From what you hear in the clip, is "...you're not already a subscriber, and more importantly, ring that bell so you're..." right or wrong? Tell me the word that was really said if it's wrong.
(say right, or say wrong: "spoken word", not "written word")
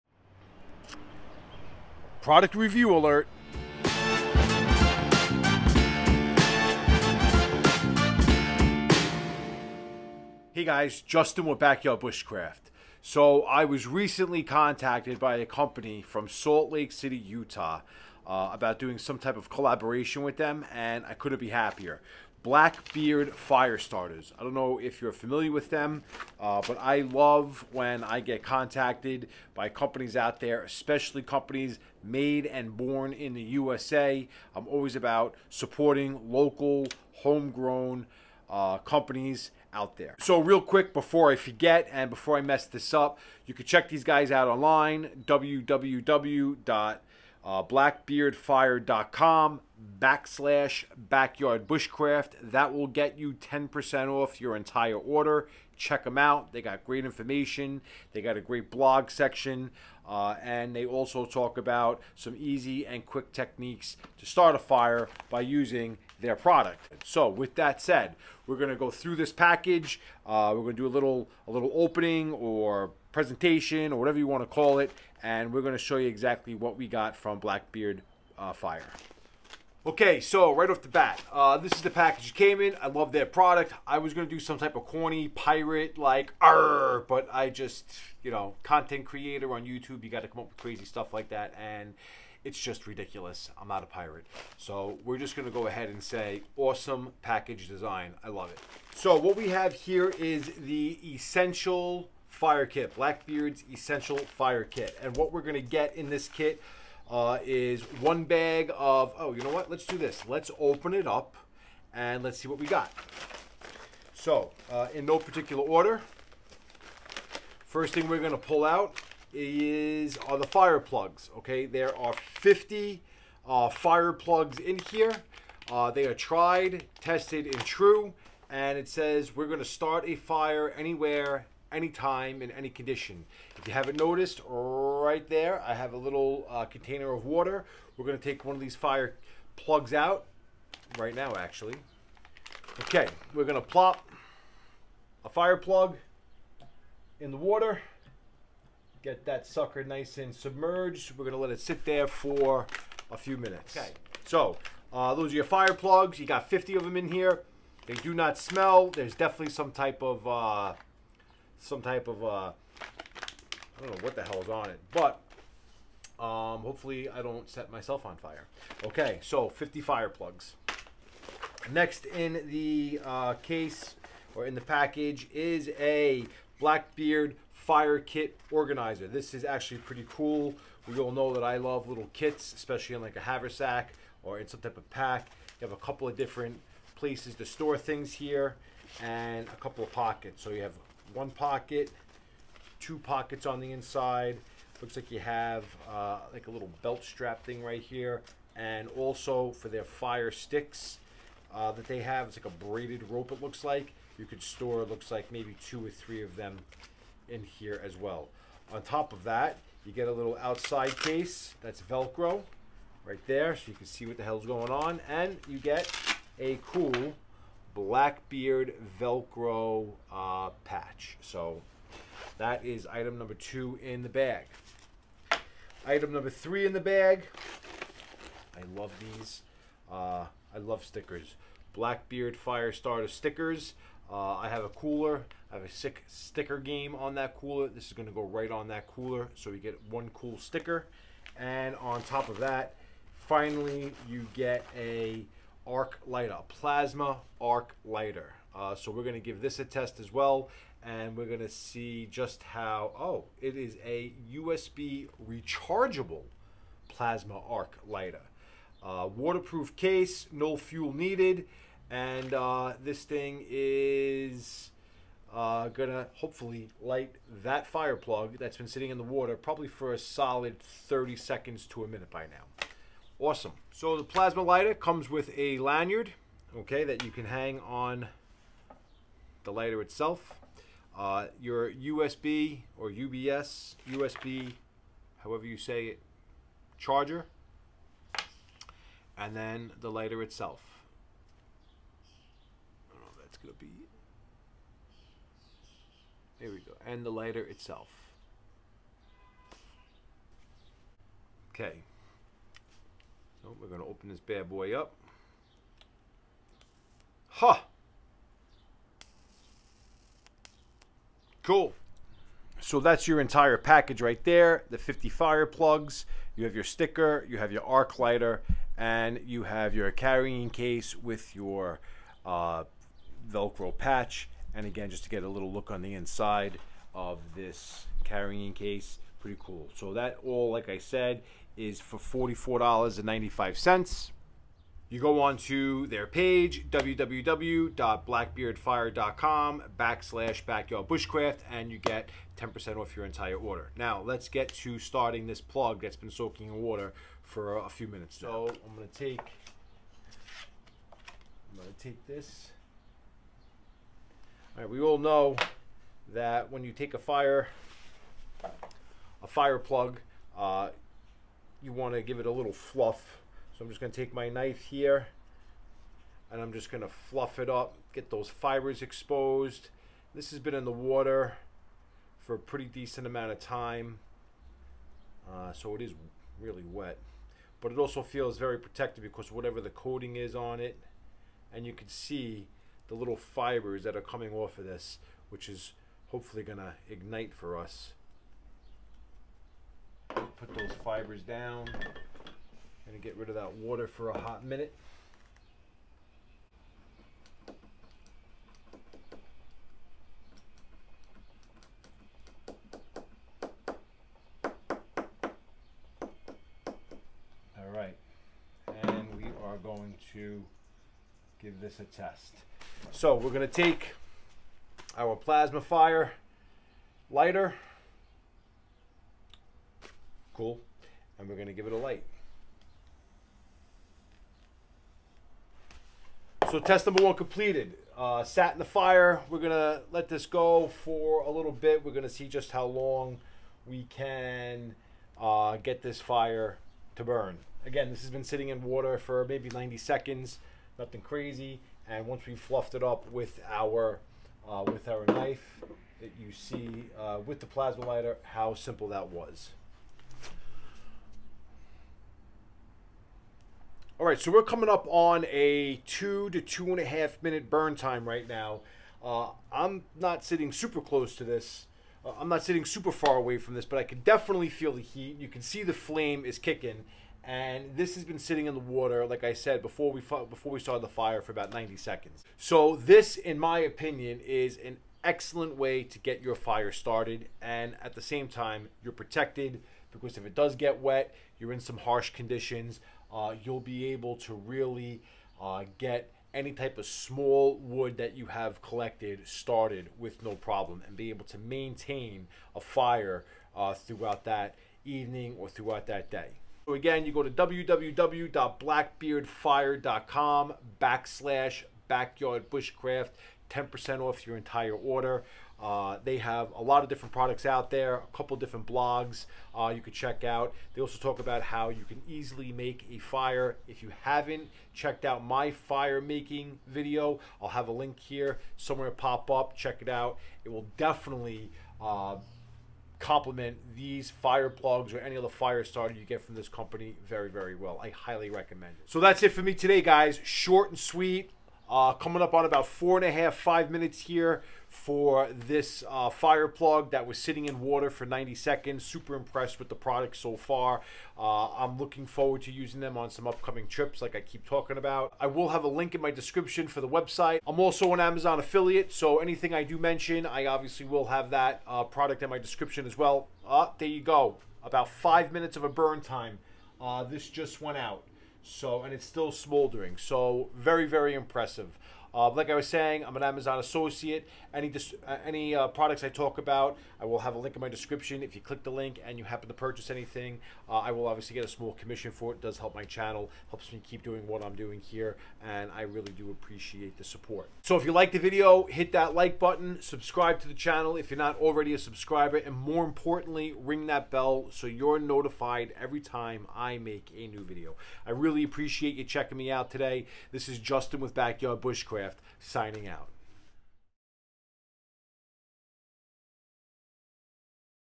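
right.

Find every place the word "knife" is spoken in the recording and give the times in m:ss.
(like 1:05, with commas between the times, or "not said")
6:04, 7:25.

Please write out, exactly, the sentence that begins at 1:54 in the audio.
So, uh, in no particular order, first thing we're going to pull out is are the fire plugs.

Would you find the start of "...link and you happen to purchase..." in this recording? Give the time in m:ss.
9:28.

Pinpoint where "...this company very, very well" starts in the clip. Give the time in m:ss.
8:46.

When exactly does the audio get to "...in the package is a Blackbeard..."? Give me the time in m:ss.
2:54.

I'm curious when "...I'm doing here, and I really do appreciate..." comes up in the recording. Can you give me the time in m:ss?
9:34.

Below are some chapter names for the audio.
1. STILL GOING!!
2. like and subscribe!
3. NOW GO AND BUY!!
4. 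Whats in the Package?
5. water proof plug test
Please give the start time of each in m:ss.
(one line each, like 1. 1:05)
1. 7:36
2. 9:26
3. 8:20
4. 1:18
5. 5:49.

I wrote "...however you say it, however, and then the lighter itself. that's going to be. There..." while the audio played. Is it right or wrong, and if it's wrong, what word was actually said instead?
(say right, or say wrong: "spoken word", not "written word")
wrong: "charger", not "however".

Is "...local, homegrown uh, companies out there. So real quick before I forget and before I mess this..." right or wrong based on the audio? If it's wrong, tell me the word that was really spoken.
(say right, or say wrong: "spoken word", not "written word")
right.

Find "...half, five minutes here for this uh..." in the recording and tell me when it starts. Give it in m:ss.
8:53.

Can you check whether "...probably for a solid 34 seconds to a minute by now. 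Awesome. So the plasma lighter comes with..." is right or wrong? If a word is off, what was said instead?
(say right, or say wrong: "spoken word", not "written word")
wrong: "30", not "34".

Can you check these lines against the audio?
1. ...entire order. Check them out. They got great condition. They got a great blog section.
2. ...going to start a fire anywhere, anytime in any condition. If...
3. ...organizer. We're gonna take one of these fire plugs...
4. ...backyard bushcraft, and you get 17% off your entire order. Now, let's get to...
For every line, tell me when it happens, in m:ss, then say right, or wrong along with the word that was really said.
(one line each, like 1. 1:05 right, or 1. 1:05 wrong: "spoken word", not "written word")
1. 0:54 wrong: "information", not "condition"
2. 2:09 right
3. 2:17 wrong: "water", not "organizer"
4. 5:40 wrong: "10", not "17".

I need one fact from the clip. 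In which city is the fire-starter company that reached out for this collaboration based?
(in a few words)
Salt Lake City.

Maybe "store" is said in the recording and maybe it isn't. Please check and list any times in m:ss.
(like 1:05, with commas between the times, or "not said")
3:07, 3:24.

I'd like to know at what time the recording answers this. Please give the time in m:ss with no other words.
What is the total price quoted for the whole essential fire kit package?
5:31.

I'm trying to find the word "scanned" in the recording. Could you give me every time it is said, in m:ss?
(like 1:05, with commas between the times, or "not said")
not said.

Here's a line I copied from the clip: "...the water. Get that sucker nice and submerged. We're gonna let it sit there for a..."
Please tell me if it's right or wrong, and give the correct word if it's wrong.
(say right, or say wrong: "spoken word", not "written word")
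right.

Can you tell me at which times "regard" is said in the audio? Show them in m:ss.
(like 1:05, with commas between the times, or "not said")
not said.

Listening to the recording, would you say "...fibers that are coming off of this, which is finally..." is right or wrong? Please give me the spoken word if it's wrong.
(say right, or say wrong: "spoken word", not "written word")
wrong: "hopefully", not "finally".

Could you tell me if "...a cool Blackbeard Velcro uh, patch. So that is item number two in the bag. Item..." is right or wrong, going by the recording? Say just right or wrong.
right.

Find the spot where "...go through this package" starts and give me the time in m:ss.
1:08.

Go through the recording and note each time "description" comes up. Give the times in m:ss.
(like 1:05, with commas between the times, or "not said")
9:06, 9:12, 9:27.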